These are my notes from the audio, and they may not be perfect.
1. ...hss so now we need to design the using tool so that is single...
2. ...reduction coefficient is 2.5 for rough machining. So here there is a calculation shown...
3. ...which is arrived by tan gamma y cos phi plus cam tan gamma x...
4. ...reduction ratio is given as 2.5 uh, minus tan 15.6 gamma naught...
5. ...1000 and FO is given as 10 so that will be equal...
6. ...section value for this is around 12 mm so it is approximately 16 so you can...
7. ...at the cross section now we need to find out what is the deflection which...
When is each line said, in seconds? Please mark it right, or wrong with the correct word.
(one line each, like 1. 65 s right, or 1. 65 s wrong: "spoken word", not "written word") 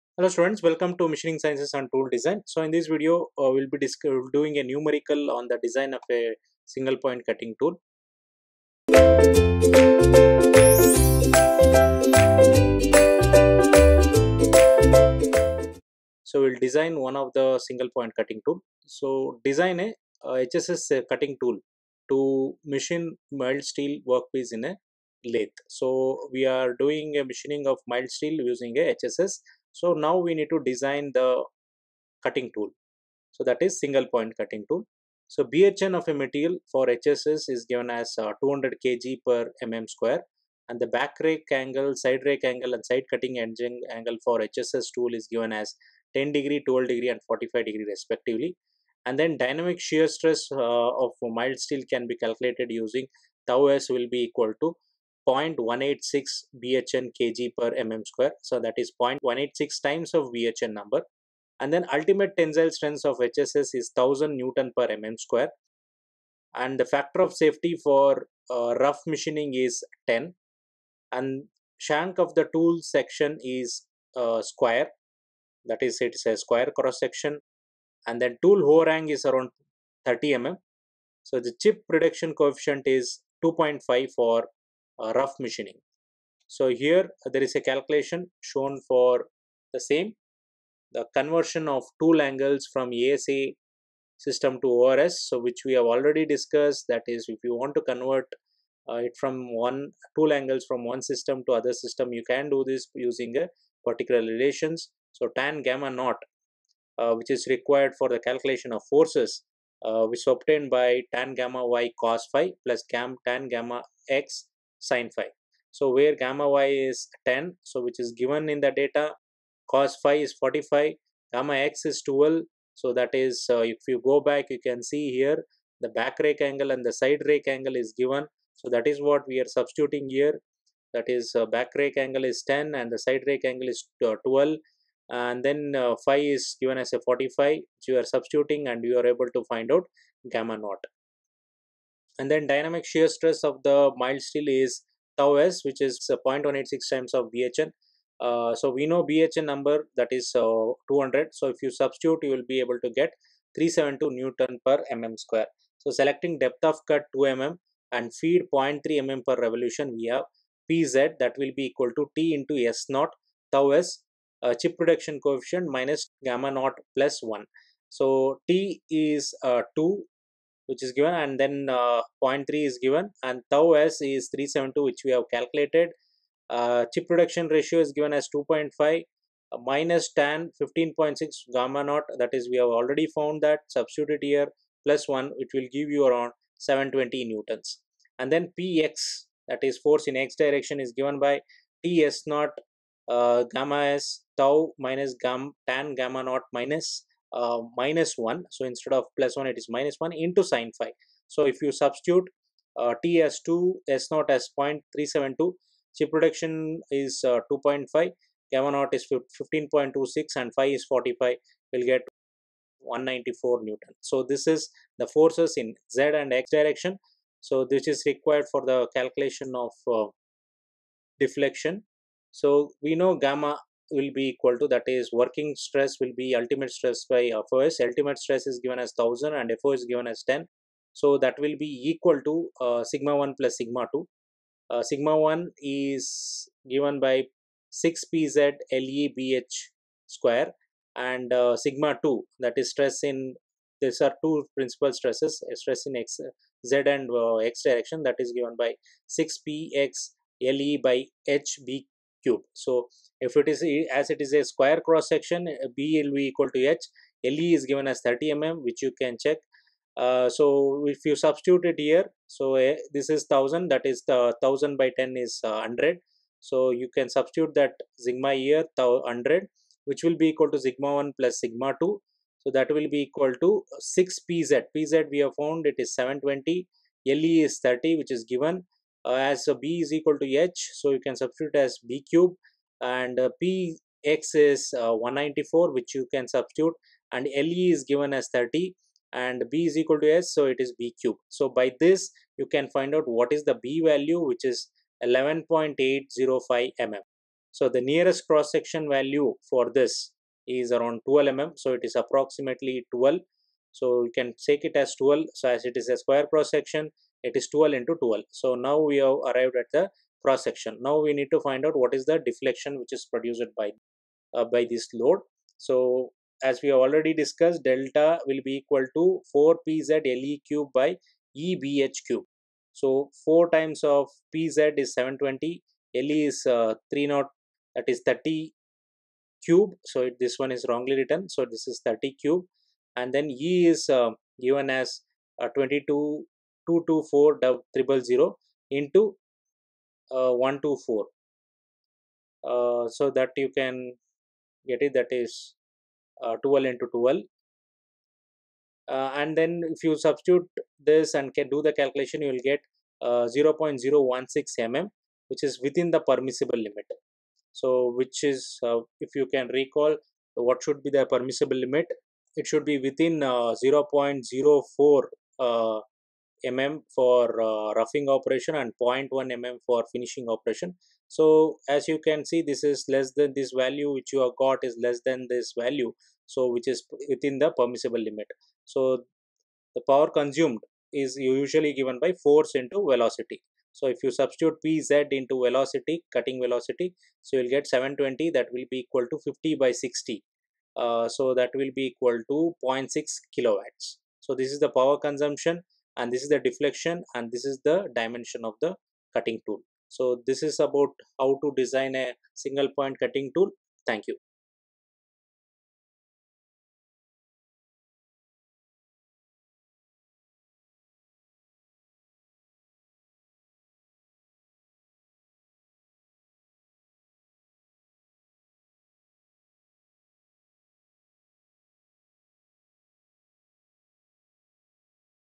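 1. 28 s wrong: "cutting", not "using"
2. 81 s right
3. 110 s wrong: "obtained", not "arrived"
4. 177 s right
5. 228 s right
6. 298 s wrong: "12", not "16"
7. 309 s right.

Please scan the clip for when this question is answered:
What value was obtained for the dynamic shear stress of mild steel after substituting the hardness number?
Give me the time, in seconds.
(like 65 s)
153 s.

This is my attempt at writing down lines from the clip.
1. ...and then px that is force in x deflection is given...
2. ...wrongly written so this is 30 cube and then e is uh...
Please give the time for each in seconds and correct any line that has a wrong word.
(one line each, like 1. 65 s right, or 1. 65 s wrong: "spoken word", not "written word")
1. 188 s wrong: "direction", not "deflection"
2. 330 s right.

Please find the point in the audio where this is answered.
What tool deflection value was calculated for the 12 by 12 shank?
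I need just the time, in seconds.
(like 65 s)
353 s.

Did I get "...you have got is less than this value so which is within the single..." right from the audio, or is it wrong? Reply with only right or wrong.
wrong.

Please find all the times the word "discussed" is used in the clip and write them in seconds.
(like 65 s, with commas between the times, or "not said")
96 s, 317 s.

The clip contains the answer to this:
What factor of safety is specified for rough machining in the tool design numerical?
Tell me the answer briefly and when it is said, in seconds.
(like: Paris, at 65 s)
10, at 66 s.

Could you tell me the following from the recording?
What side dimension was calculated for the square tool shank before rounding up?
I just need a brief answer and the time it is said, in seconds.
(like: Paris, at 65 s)
11.805 mm, at 295 s.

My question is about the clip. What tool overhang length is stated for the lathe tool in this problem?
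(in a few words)
30 mm.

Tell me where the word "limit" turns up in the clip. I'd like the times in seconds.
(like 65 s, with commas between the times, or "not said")
356 s, 361 s, 377 s.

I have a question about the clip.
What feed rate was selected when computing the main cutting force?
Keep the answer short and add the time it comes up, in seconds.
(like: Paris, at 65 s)
0.3 mm per revolution, at 158 s.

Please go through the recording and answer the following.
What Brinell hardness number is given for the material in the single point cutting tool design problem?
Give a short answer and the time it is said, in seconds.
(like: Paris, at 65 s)
200 kg per mm square, at 38 s.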